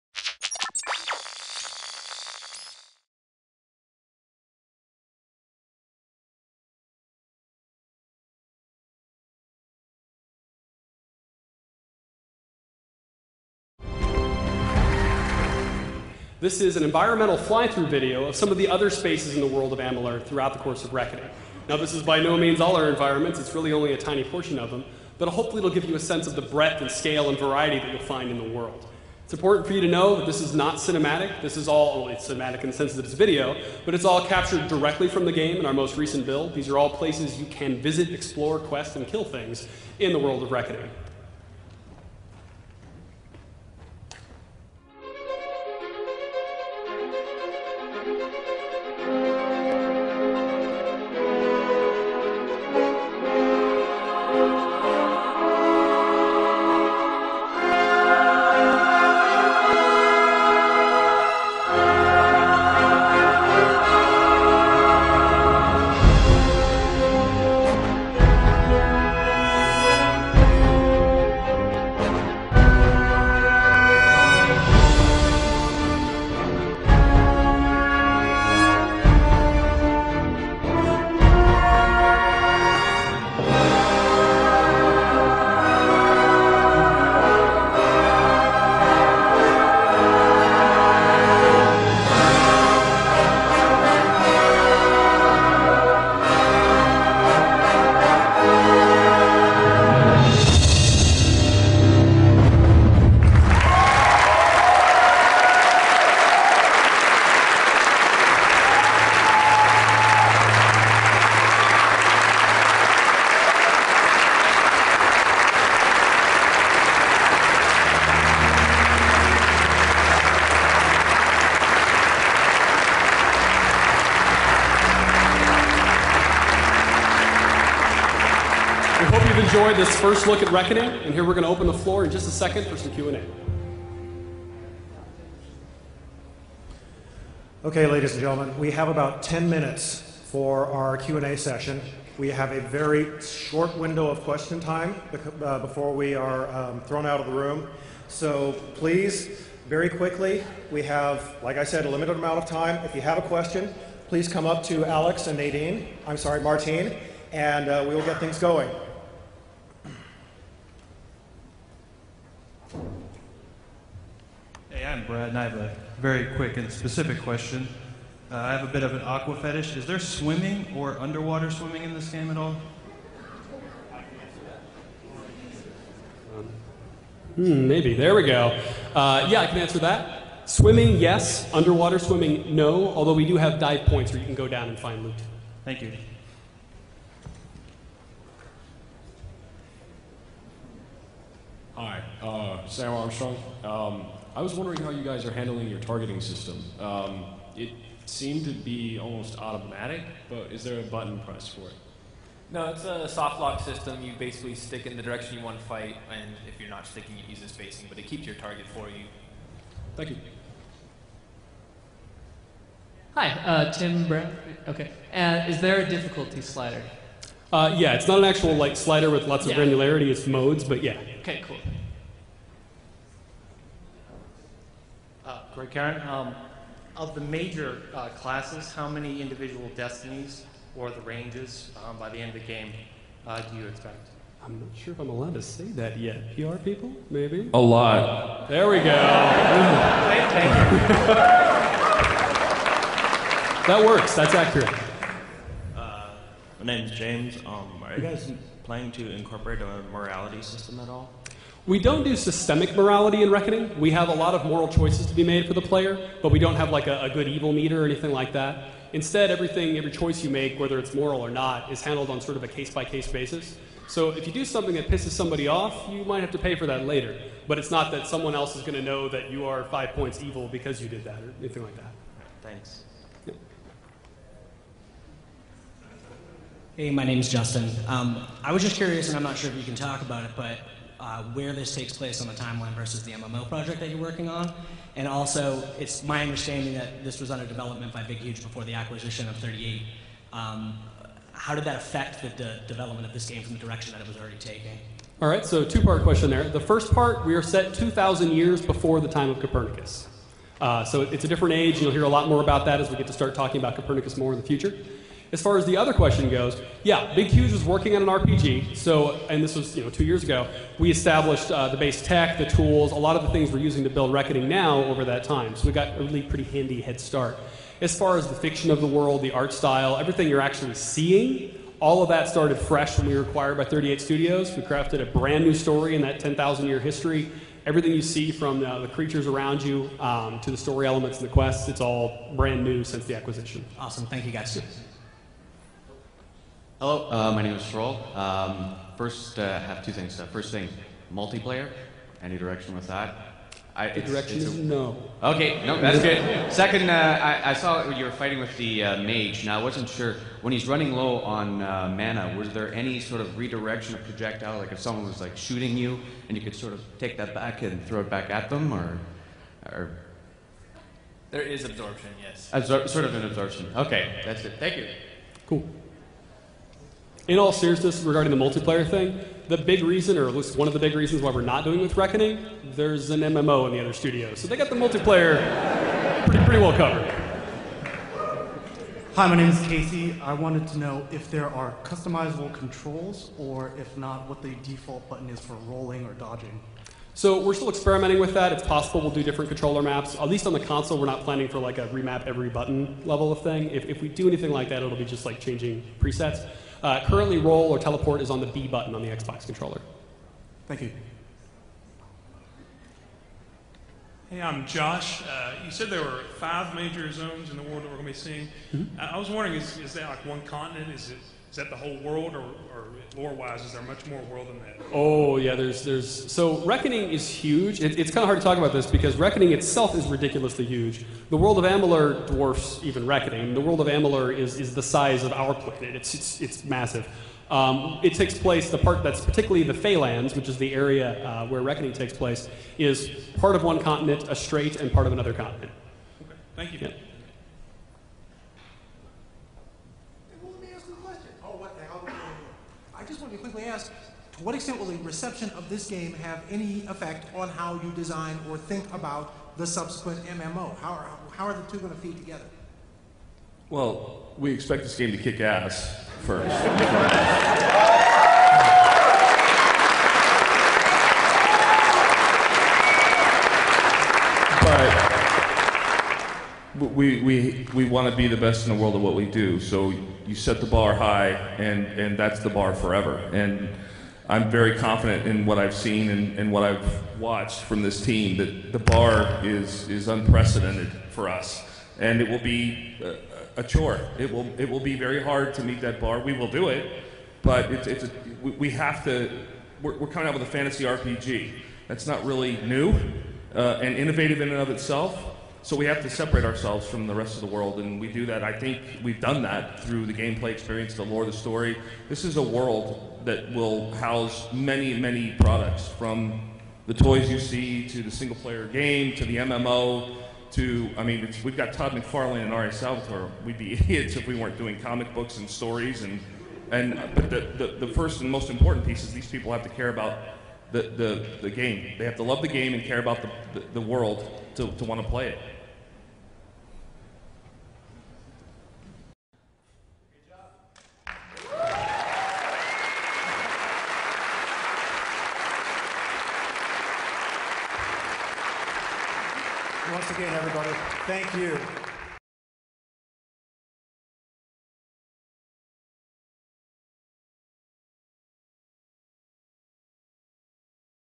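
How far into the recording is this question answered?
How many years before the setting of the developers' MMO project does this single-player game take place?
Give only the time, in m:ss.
4:57.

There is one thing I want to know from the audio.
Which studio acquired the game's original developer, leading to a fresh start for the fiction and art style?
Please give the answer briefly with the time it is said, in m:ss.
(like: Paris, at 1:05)
38 Studios, at 5:23.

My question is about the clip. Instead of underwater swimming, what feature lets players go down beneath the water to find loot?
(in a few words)
Dive points.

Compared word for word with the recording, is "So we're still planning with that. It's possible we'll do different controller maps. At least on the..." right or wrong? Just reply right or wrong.
wrong.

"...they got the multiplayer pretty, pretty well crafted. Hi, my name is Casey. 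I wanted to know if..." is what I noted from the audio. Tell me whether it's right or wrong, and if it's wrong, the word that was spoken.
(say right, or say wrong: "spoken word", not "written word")
wrong: "covered", not "crafted".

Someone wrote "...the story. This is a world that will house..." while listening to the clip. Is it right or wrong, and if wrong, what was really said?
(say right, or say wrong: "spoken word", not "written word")
right.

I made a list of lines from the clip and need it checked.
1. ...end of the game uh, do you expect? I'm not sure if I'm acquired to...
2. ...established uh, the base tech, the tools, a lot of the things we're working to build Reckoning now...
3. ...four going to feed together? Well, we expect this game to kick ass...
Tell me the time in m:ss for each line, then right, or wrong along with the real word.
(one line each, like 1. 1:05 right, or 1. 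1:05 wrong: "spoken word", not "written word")
1. 3:52 wrong: "allowed", not "acquired"
2. 5:10 wrong: "using", not "working"
3. 7:31 wrong: "two", not "four".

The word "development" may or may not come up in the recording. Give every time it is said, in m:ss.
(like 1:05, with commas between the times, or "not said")
4:47, 4:52.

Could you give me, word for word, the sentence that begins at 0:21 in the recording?
Now, this is by no means all our environments.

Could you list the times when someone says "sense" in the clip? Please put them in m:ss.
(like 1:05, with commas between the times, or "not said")
0:25, 0:32.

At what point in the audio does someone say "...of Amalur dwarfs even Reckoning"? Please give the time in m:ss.
7:01.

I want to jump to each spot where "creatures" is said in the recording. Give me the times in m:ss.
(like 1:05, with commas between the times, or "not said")
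5:28.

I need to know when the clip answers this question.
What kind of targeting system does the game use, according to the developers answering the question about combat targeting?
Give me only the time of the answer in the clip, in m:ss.
3:23.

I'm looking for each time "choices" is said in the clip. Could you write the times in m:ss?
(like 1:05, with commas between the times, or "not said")
4:14, 4:19.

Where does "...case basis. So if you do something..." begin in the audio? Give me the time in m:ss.
4:22.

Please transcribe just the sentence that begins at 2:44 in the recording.
Hey, I'm Brad, and I have a very quick and specific question.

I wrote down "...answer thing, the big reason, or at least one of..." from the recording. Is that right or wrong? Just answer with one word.
wrong.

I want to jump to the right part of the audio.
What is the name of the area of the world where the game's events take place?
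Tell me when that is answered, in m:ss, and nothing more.
7:09.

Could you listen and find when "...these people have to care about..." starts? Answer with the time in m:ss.
8:39.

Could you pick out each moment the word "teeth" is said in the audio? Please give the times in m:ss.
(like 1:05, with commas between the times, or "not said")
not said.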